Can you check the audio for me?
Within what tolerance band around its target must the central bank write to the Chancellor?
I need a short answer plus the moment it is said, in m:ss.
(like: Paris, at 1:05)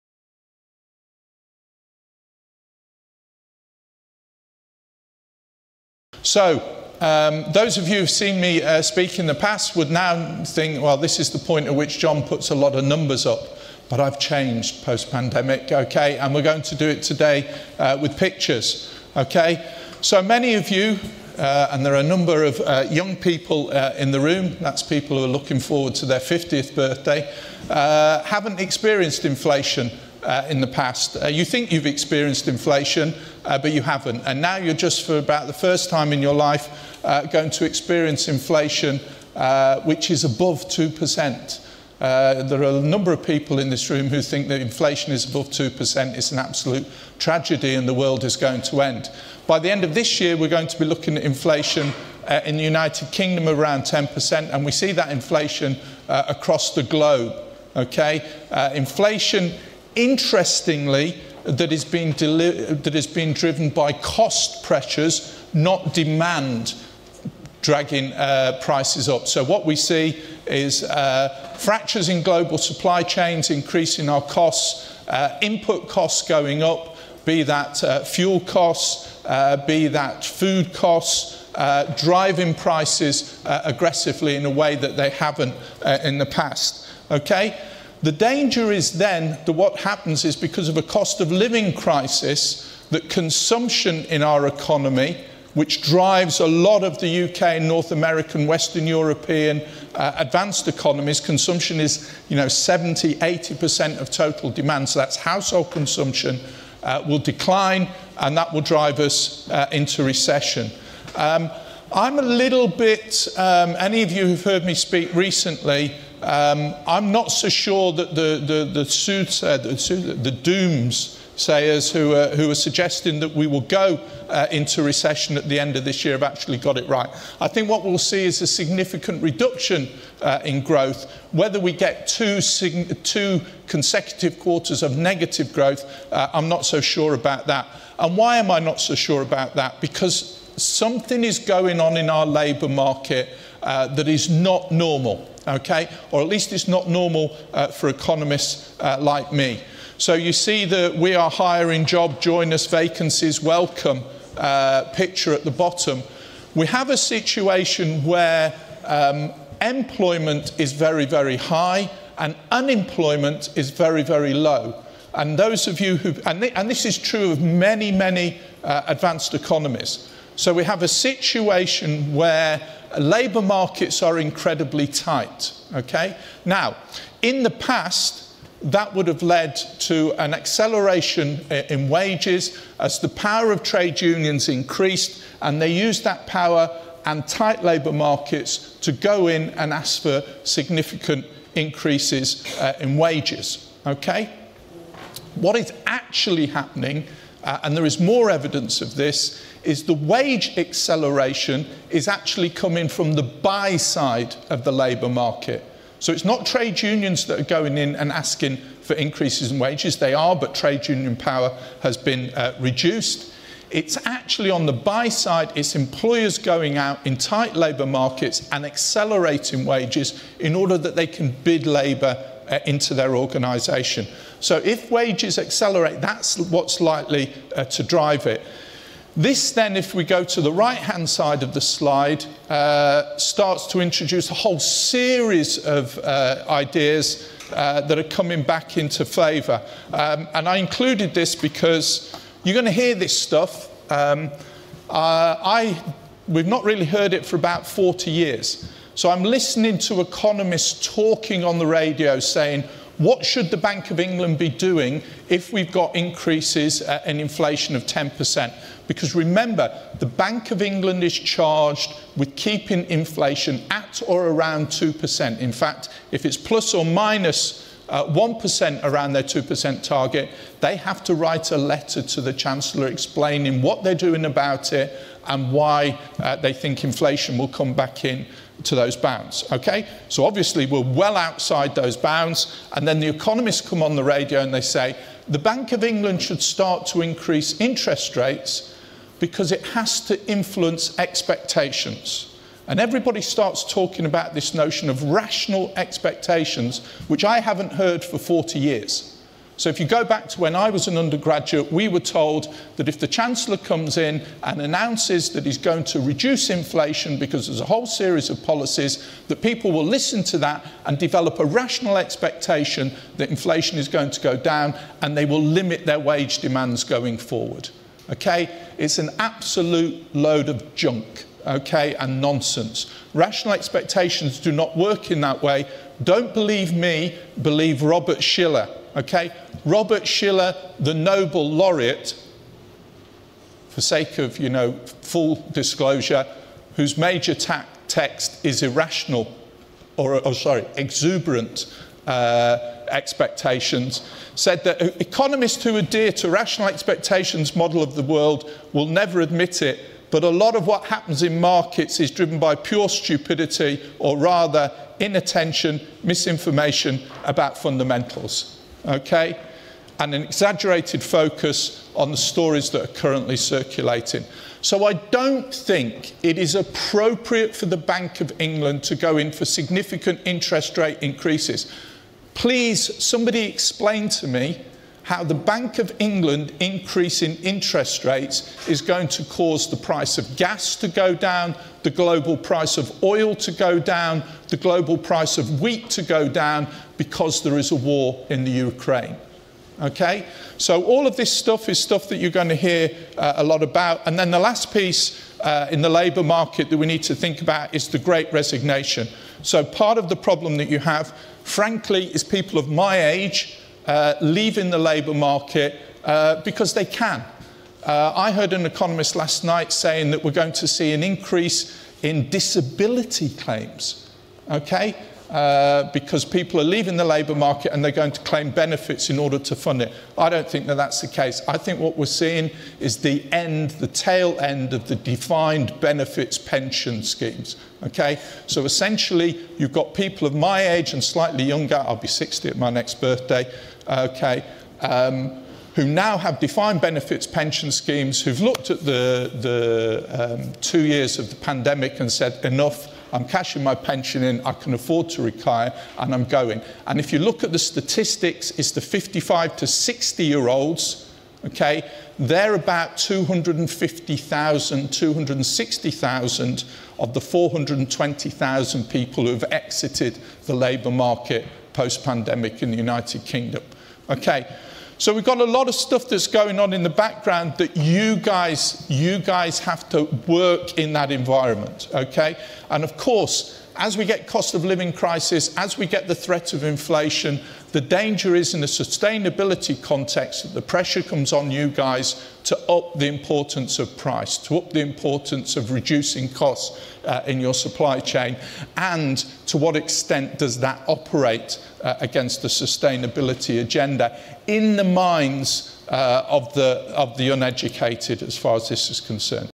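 plus or minus 1%, at 4:26.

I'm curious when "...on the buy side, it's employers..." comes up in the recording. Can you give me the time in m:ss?
3:34.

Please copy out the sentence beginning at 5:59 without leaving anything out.
And an exaggerated focus on the stories that are currently circulating.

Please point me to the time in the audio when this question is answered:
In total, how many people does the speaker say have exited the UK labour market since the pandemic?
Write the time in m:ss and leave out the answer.
7:37.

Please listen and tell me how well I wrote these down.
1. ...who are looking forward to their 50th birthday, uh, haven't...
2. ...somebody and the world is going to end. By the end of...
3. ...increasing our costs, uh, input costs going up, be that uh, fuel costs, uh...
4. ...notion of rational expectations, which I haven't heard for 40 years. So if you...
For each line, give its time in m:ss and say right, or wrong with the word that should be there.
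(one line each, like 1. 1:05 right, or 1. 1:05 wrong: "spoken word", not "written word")
1. 0:25 right
2. 0:47 wrong: "tragedy", not "somebody"
3. 1:13 right
4. 4:54 right.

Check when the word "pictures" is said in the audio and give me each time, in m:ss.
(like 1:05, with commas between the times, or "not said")
0:18, 2:34.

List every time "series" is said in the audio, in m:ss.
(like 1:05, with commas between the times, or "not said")
3:54, 5:07.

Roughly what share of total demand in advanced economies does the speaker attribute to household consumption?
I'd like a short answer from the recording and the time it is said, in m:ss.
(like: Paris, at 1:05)
70-80%, at 1:42.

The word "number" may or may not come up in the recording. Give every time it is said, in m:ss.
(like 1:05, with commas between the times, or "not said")
0:12, 0:22, 0:42.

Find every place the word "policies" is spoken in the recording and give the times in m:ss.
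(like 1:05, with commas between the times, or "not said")
5:08.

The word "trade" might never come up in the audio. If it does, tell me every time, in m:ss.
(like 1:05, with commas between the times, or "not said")
3:03, 3:26, 3:30.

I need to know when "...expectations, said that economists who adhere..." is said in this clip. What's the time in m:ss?
5:42.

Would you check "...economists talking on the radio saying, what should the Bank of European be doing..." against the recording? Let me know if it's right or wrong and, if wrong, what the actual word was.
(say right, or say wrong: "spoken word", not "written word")
wrong: "England", not "European".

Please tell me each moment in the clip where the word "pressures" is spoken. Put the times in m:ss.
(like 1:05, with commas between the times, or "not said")
1:04, 8:00.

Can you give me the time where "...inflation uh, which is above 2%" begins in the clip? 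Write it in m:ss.
0:38.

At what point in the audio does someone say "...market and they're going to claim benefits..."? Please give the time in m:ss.
6:57.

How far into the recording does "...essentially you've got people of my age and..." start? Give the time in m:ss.
7:08.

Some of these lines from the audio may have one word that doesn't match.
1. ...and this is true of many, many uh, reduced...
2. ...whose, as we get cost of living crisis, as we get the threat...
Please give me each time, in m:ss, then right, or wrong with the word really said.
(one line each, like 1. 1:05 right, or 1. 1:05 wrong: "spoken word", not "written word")
1. 2:46 wrong: "advanced", not "reduced"
2. 7:52 wrong: "course", not "whose".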